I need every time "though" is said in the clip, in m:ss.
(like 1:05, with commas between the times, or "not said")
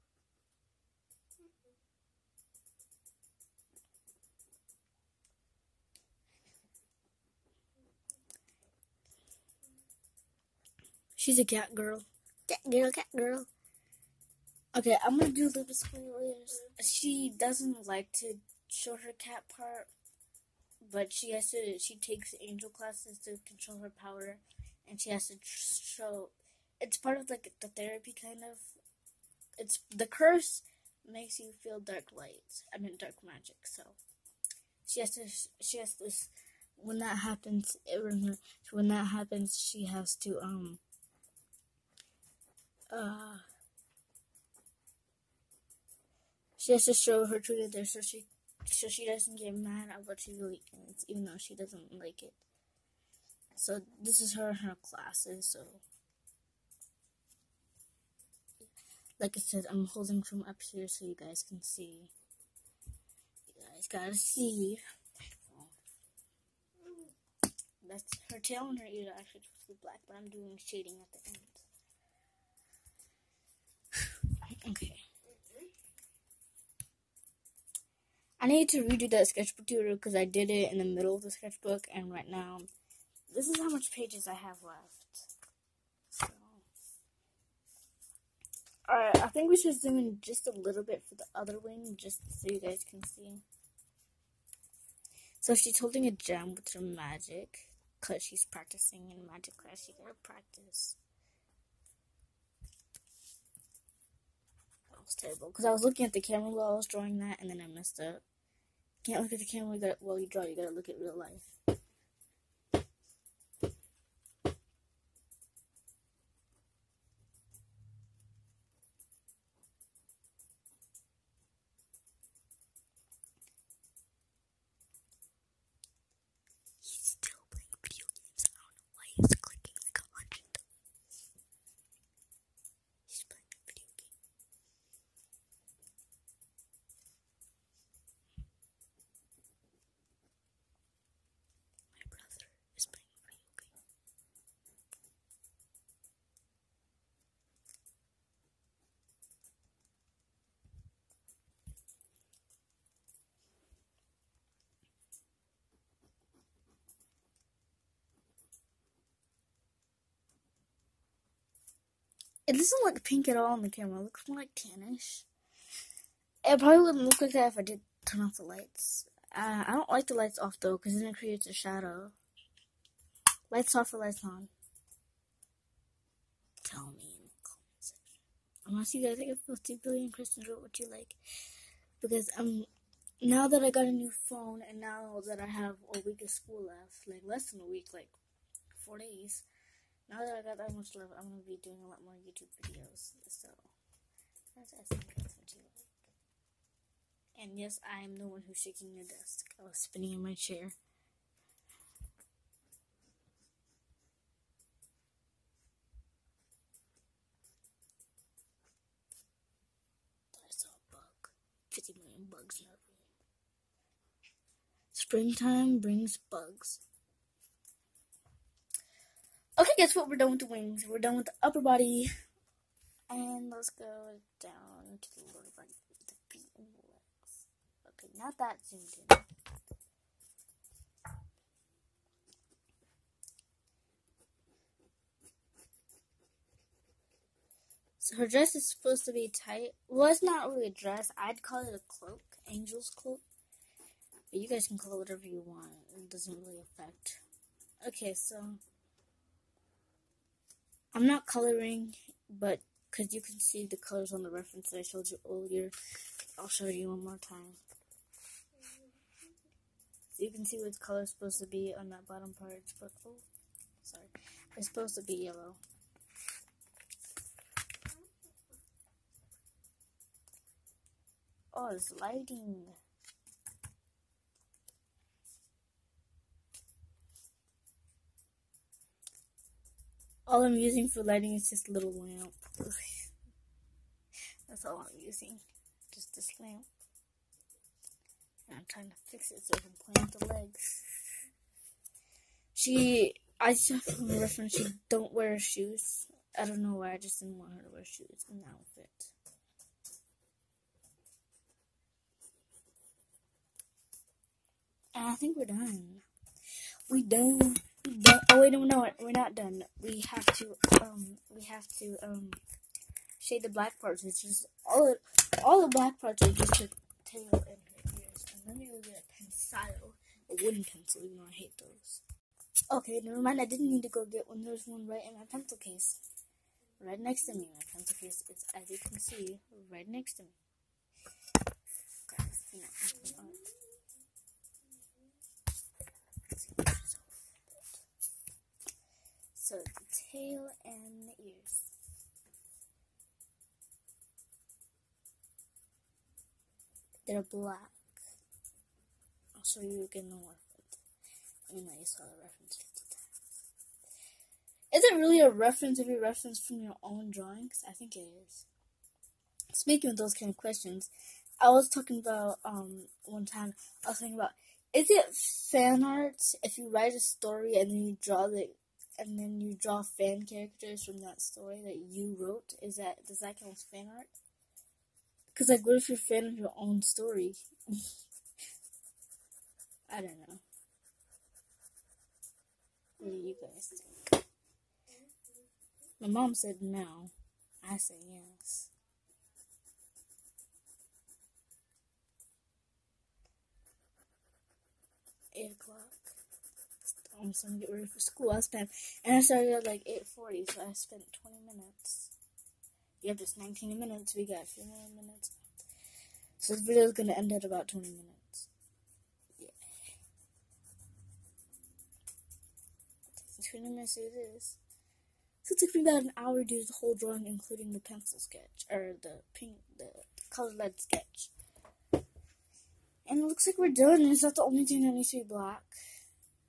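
0:51, 2:50, 5:21.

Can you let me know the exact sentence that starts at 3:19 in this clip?
I was spinning in my chair.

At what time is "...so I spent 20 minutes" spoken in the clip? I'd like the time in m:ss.
6:40.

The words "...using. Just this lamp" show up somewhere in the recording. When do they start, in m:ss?
4:44.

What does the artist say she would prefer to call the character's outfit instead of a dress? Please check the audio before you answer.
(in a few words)
angel's cloak.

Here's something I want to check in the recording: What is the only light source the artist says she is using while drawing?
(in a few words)
a little lamp.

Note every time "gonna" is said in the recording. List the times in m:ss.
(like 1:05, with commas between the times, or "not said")
0:15, 3:11, 6:37, 6:46.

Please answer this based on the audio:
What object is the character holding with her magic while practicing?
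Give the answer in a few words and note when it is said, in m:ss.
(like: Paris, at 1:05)
a gem, at 1:36.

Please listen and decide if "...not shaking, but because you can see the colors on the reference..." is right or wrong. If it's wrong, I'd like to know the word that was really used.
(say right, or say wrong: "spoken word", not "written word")
wrong: "coloring", not "shaking".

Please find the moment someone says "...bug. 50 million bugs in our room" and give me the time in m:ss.
3:30.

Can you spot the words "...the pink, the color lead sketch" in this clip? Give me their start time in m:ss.
6:59.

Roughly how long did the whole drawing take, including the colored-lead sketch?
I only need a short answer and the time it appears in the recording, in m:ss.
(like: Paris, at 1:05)
about an hour, at 6:55.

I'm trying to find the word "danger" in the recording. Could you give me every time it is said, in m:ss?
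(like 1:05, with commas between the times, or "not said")
not said.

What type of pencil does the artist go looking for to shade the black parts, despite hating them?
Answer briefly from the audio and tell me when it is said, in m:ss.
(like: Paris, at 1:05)
wooden pencil, at 5:20.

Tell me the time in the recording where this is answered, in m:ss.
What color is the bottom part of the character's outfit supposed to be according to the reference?
4:25.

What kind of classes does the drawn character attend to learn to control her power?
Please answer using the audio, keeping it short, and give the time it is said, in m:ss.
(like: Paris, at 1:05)
angel classes, at 0:22.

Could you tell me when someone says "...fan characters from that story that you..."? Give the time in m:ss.
6:09.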